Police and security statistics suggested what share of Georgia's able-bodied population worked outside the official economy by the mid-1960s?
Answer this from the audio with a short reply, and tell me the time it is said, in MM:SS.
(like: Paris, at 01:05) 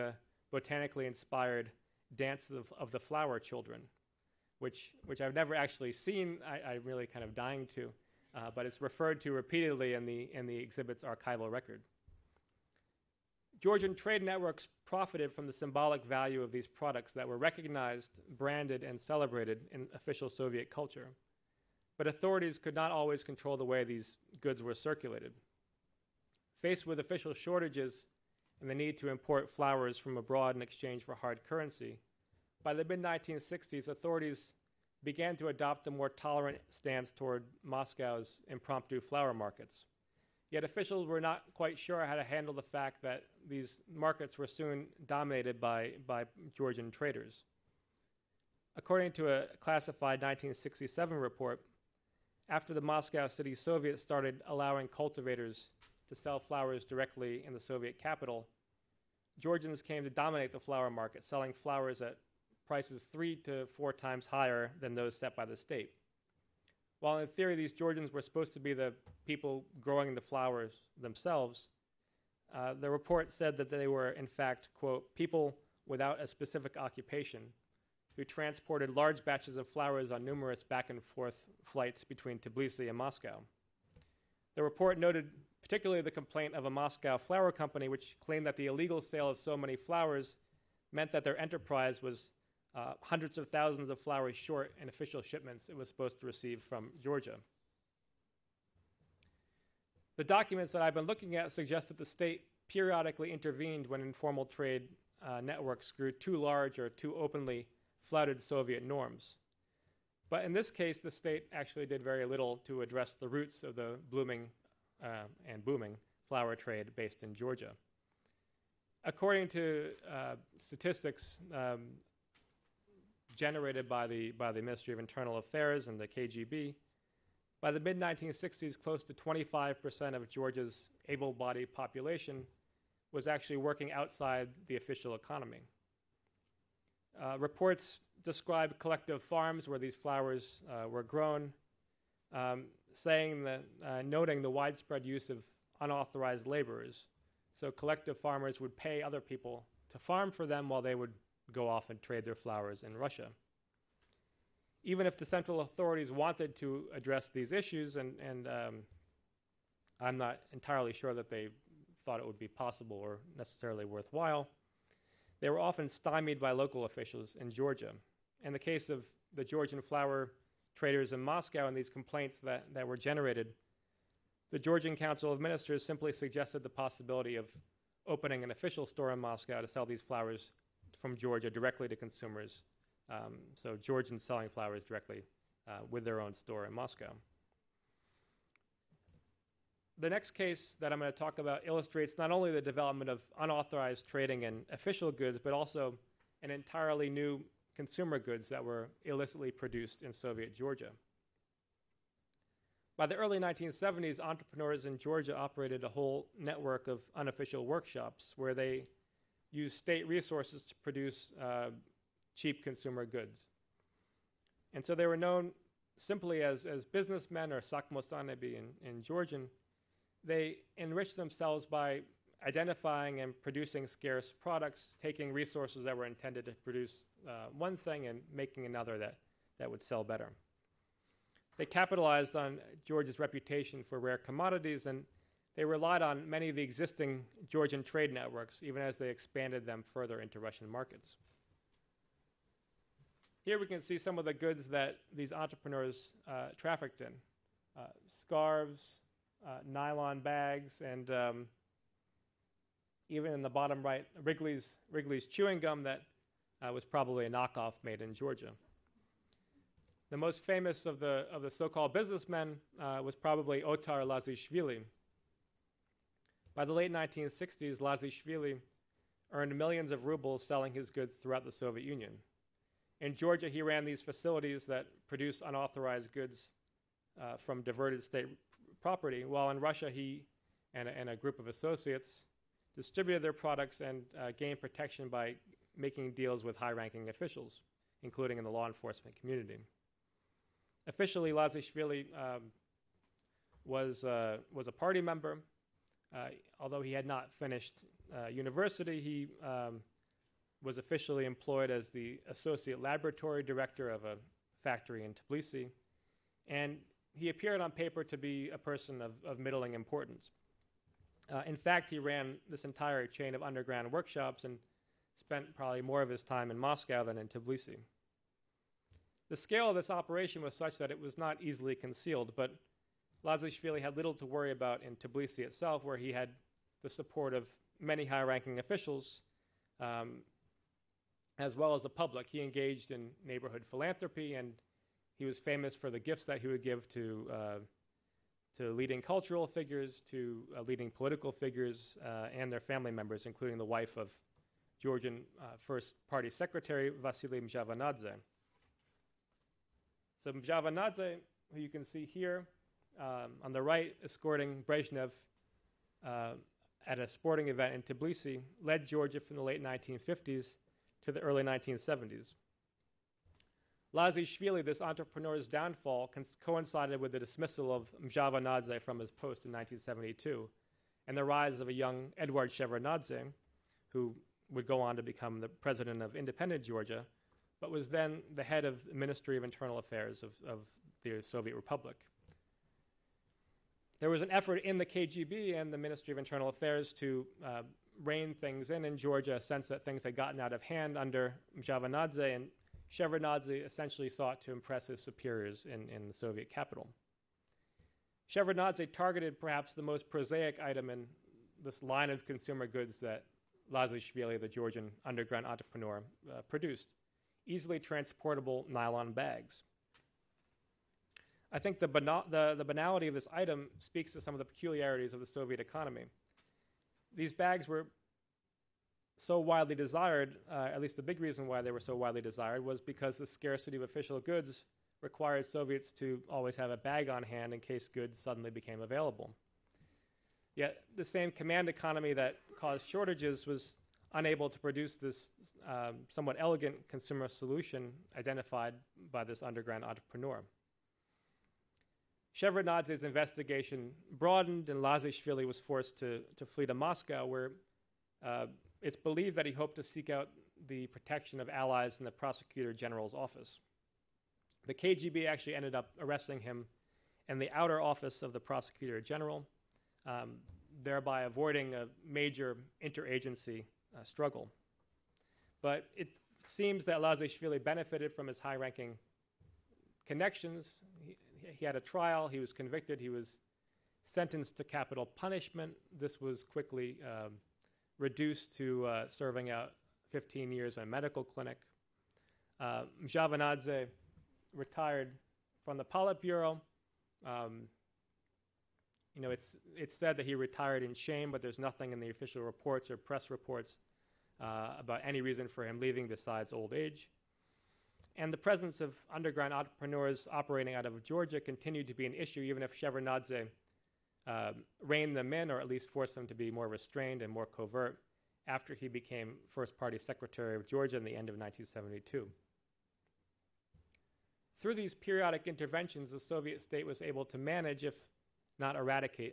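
25%, at 02:09.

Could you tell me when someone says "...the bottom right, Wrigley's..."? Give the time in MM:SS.
04:13.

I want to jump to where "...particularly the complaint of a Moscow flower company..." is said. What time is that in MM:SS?
01:25.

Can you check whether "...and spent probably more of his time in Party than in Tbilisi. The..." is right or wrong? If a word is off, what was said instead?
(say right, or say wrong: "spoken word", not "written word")
wrong: "Moscow", not "Party".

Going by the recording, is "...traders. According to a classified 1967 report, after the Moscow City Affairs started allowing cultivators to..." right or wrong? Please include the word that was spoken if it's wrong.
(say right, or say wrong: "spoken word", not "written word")
wrong: "Soviet", not "Affairs".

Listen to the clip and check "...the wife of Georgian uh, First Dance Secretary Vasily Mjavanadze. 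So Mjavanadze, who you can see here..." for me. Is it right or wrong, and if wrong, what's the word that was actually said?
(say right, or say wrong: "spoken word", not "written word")
wrong: "Party", not "Dance".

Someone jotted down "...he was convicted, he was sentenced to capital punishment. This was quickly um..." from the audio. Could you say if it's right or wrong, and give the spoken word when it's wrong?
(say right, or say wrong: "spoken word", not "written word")
right.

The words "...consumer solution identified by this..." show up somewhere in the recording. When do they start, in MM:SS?
07:16.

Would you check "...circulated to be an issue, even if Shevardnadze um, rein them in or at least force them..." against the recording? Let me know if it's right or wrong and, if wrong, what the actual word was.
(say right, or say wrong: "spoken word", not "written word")
wrong: "continued", not "circulated".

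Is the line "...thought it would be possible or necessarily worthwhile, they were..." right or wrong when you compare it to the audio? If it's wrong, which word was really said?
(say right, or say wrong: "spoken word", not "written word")
right.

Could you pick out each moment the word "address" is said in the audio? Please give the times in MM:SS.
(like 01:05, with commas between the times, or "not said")
01:52, 02:36.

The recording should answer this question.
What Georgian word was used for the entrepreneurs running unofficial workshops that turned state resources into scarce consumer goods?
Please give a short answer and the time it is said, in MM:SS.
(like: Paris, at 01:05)
sakmosanebi, at 03:37.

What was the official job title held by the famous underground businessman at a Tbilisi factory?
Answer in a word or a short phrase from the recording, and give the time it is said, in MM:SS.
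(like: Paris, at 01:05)
associate laboratory director, at 05:02.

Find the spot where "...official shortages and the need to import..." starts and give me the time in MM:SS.
00:26.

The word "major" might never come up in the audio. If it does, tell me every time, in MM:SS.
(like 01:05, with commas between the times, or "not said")
07:42.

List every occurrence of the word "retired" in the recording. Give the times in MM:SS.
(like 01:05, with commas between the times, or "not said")
08:04, 08:10.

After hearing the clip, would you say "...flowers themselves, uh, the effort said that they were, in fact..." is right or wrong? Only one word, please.
wrong.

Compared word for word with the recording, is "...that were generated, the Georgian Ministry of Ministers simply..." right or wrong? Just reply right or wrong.
wrong.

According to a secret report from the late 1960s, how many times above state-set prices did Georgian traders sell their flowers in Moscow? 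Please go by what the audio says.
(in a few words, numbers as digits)
3 to 4 times.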